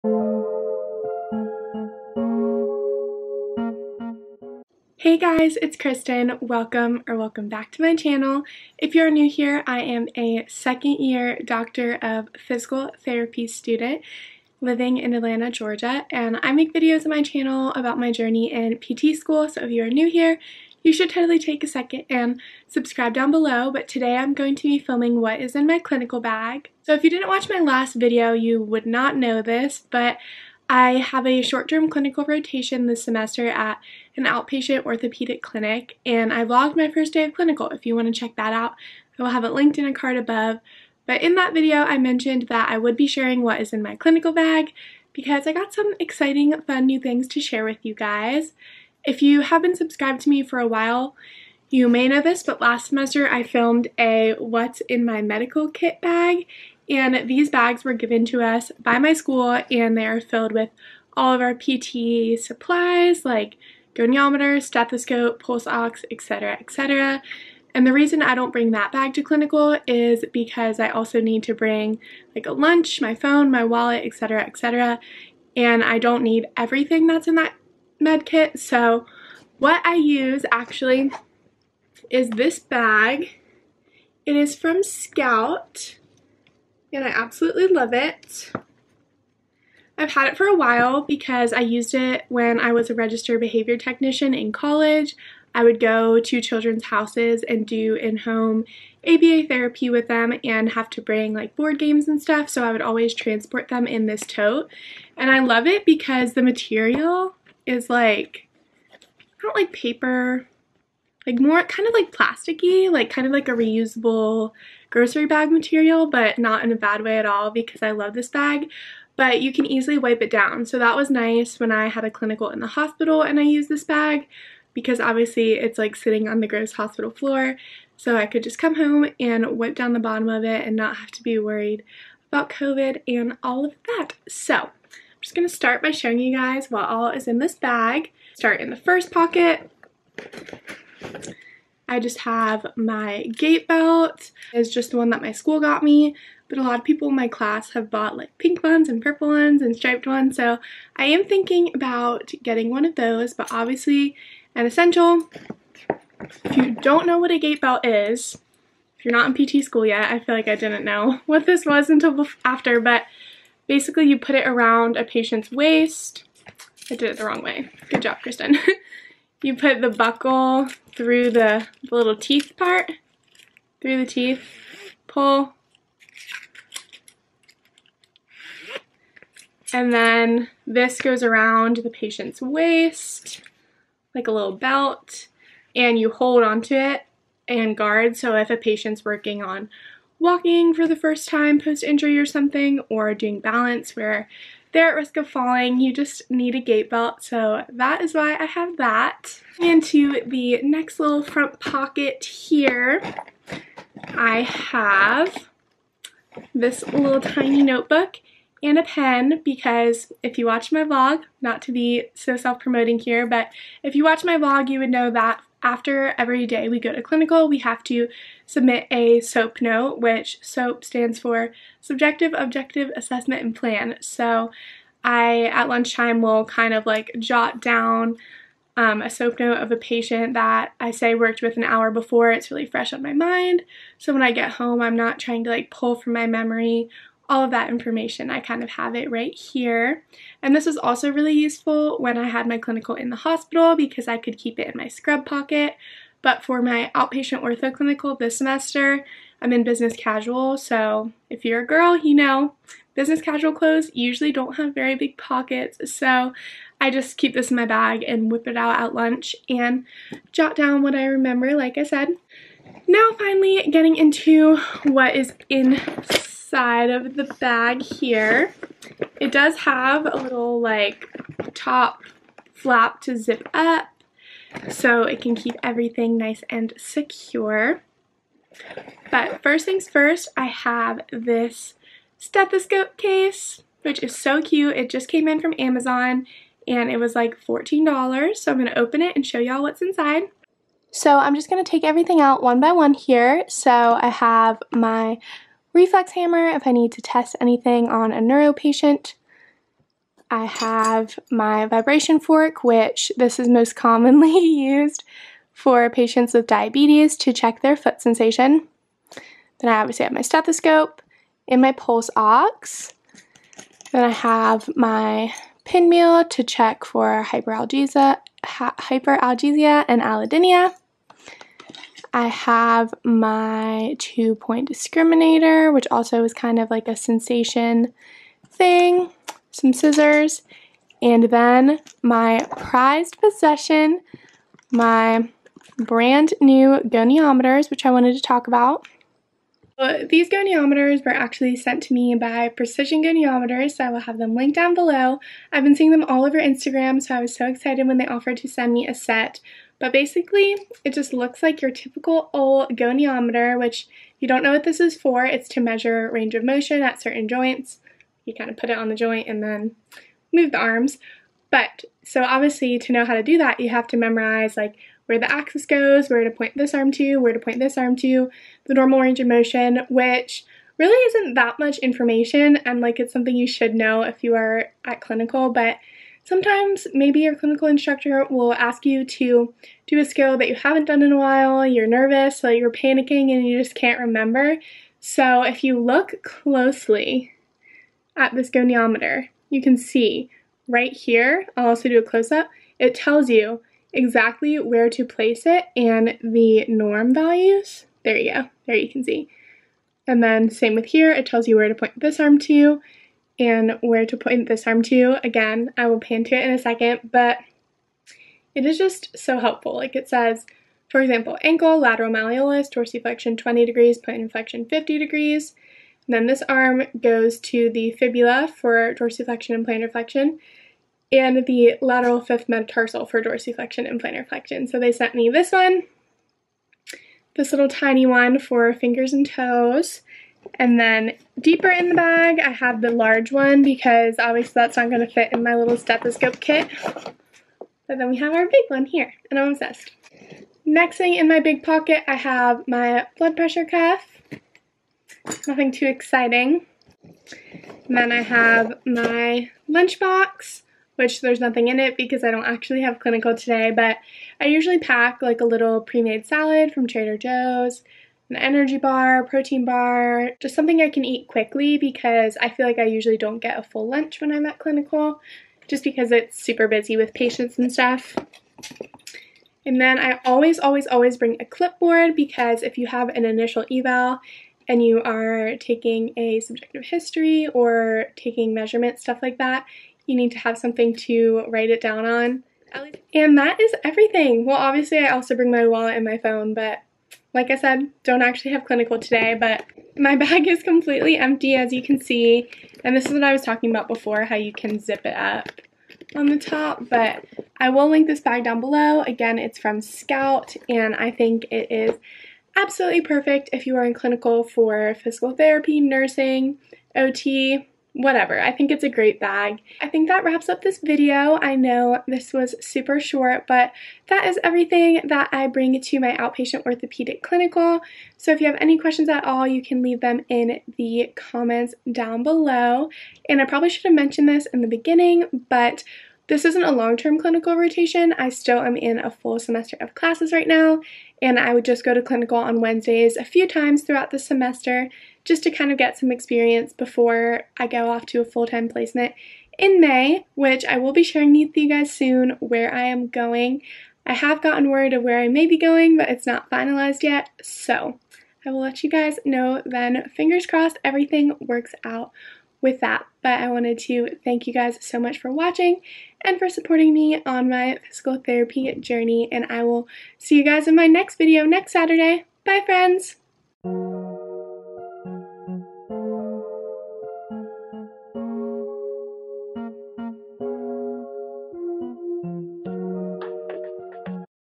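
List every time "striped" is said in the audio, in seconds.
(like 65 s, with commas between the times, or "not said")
149 s.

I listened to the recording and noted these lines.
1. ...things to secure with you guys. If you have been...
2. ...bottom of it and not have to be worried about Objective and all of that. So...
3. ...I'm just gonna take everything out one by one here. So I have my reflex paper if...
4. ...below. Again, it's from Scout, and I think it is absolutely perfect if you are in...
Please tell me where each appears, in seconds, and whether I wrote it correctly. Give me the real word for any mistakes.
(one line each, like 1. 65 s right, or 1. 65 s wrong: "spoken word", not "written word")
1. 46 s wrong: "share", not "secure"
2. 129 s wrong: "COVID", not "Objective"
3. 291 s wrong: "hammer", not "paper"
4. 498 s right.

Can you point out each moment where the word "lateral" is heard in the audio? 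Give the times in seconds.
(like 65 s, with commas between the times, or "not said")
411 s, 421 s.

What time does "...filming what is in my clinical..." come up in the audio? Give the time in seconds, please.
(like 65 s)
24 s.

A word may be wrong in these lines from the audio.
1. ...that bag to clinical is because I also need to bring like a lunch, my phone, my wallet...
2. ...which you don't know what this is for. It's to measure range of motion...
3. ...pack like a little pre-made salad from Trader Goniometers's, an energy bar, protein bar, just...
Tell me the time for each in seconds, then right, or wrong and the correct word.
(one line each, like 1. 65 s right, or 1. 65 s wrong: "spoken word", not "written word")
1. 68 s right
2. 353 s right
3. 454 s wrong: "Joe", not "Goniometers".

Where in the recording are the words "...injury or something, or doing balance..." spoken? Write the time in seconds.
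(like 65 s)
191 s.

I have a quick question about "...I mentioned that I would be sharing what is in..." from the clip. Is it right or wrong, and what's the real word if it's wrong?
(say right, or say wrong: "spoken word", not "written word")
right.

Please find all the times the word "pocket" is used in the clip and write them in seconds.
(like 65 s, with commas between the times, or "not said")
139 s, 201 s, 245 s, 255 s, 441 s.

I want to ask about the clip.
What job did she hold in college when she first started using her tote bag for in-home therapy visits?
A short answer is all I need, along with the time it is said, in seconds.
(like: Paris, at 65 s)
Registered behavior technician, at 92 s.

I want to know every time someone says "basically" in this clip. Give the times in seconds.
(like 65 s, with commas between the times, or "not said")
163 s, 349 s.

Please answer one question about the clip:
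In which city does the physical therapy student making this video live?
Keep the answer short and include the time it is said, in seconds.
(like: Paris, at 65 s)
Atlanta, Georgia, at 15 s.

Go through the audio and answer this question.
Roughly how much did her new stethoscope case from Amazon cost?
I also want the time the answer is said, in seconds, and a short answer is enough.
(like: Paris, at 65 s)
$14, at 287 s.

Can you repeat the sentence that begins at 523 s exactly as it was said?
And I probably should have mentioned this in the beginning, but this isn't a long-term clinical rotation.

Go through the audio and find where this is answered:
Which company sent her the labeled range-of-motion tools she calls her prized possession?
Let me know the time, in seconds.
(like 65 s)
342 s.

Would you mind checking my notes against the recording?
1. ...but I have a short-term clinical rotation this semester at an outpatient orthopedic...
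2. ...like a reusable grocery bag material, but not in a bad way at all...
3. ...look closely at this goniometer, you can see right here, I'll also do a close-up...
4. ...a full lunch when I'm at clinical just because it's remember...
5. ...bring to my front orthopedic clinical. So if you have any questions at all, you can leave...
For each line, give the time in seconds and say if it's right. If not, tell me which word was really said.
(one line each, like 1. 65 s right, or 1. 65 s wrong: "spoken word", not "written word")
1. 29 s right
2. 113 s right
3. 385 s right
4. 463 s wrong: "super", not "remember"
5. 515 s wrong: "outpatient", not "front".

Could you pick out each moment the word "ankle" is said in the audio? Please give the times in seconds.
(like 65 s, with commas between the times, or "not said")
411 s.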